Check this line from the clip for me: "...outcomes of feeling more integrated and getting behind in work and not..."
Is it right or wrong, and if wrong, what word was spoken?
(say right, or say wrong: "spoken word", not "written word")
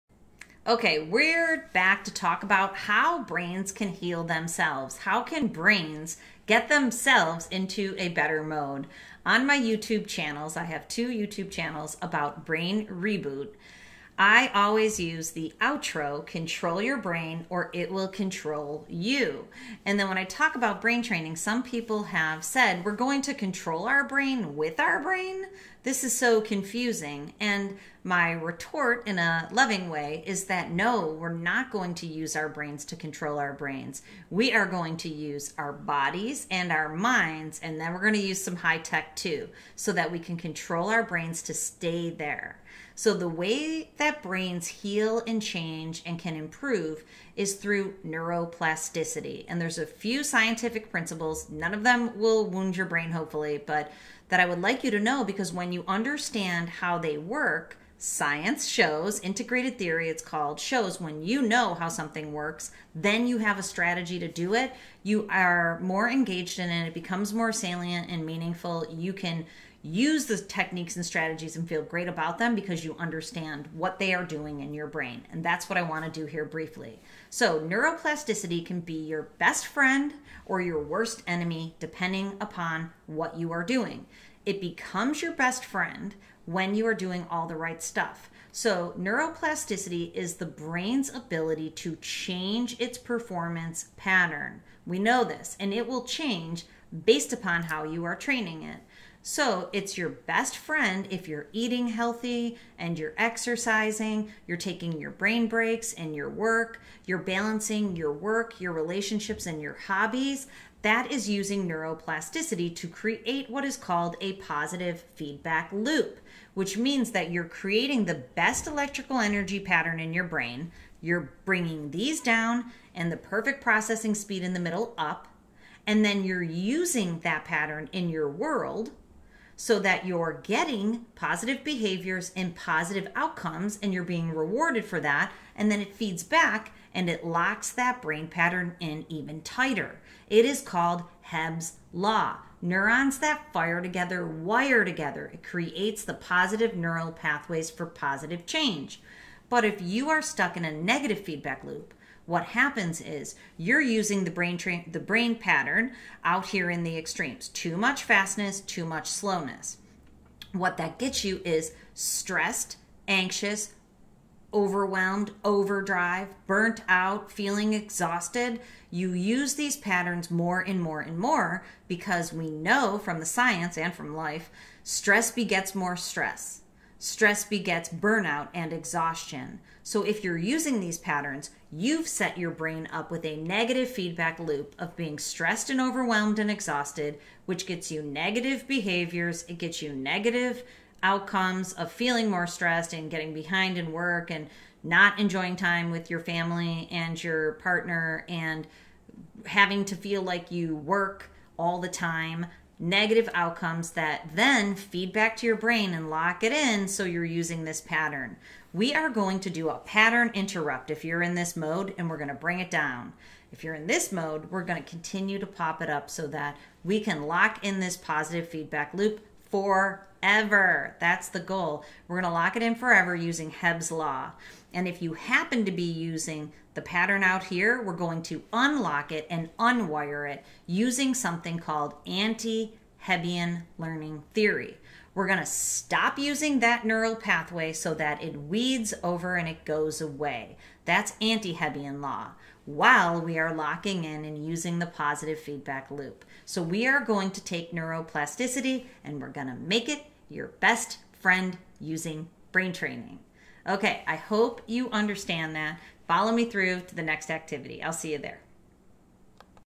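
wrong: "stressed", not "integrated".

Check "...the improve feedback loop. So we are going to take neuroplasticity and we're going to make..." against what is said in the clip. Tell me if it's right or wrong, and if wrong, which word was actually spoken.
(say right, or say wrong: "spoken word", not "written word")
wrong: "positive", not "improve".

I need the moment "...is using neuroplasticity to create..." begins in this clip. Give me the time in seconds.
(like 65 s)
111 s.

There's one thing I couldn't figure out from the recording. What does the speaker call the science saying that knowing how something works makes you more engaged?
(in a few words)
Integrated theory.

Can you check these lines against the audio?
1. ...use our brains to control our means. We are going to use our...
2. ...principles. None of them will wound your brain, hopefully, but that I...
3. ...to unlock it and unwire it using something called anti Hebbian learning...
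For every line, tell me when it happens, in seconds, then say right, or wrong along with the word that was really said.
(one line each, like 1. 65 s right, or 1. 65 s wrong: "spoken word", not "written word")
1. 32 s wrong: "brains", not "means"
2. 50 s right
3. 228 s right.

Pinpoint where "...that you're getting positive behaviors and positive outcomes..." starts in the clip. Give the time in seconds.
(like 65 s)
129 s.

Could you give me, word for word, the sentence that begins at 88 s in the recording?
So, neuroplasticity is the brain's ability to change its performance pattern.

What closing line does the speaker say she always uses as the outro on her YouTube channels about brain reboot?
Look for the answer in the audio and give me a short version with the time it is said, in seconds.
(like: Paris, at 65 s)
Control your brain or it will control you, at 16 s.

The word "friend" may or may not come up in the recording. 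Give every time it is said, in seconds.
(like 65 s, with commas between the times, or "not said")
79 s, 85 s, 100 s, 251 s.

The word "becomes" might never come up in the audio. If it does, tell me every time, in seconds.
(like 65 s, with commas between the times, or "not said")
66 s, 84 s.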